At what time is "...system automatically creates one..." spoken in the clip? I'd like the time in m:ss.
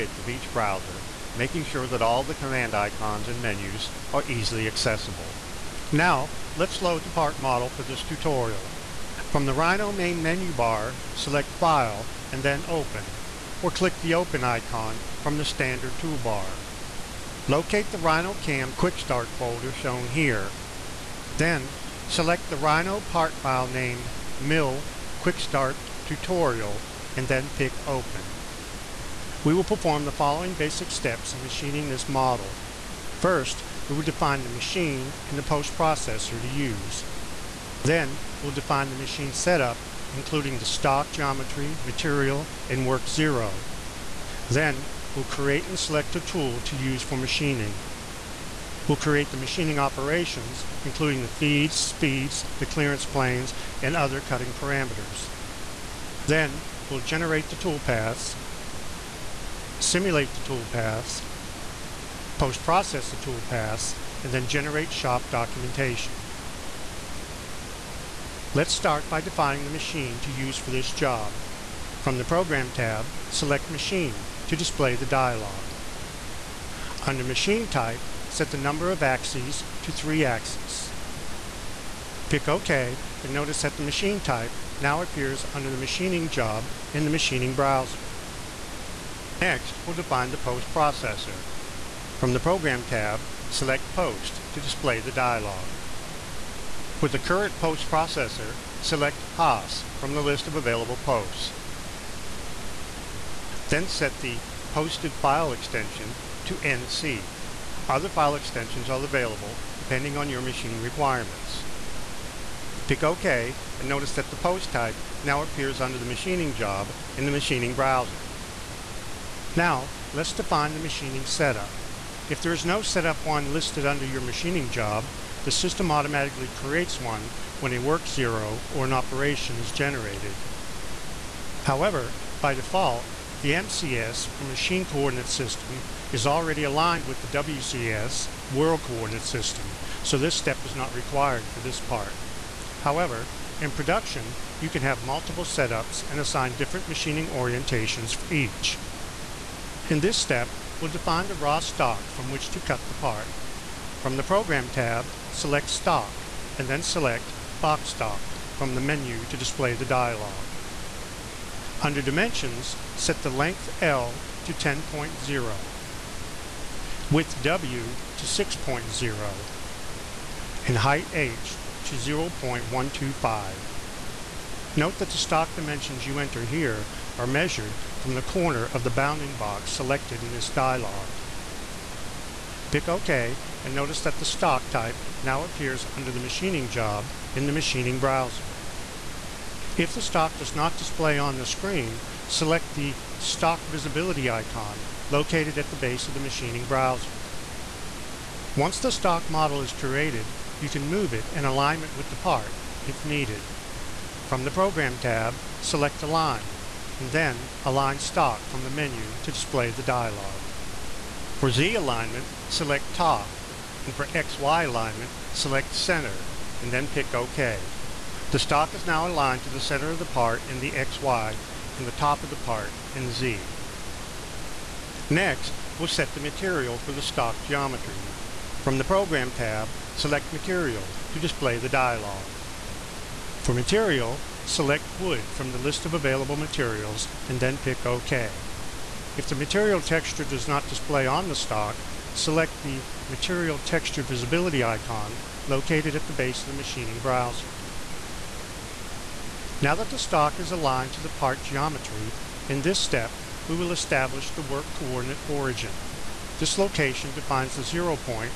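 2:05.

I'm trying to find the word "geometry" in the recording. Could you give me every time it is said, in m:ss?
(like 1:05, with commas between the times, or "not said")
0:41, 3:47, 4:11.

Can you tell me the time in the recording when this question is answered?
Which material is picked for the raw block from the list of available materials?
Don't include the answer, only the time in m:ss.
3:54.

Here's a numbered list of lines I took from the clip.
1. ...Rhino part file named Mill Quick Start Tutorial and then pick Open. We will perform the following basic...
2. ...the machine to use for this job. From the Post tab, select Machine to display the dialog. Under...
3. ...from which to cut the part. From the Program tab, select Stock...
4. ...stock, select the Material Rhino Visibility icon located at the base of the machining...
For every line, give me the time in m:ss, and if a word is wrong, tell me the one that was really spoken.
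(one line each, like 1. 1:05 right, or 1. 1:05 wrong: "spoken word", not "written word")
1. 0:22 right
2. 1:09 wrong: "Program", not "Post"
3. 2:32 right
4. 4:01 wrong: "Texture", not "Rhino".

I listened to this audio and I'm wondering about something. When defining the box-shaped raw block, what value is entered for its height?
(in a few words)
0.125.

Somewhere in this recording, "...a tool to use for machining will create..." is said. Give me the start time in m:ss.
0:46.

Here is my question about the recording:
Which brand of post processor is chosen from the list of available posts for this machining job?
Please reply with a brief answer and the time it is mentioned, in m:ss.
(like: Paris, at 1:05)
Haas, at 1:39.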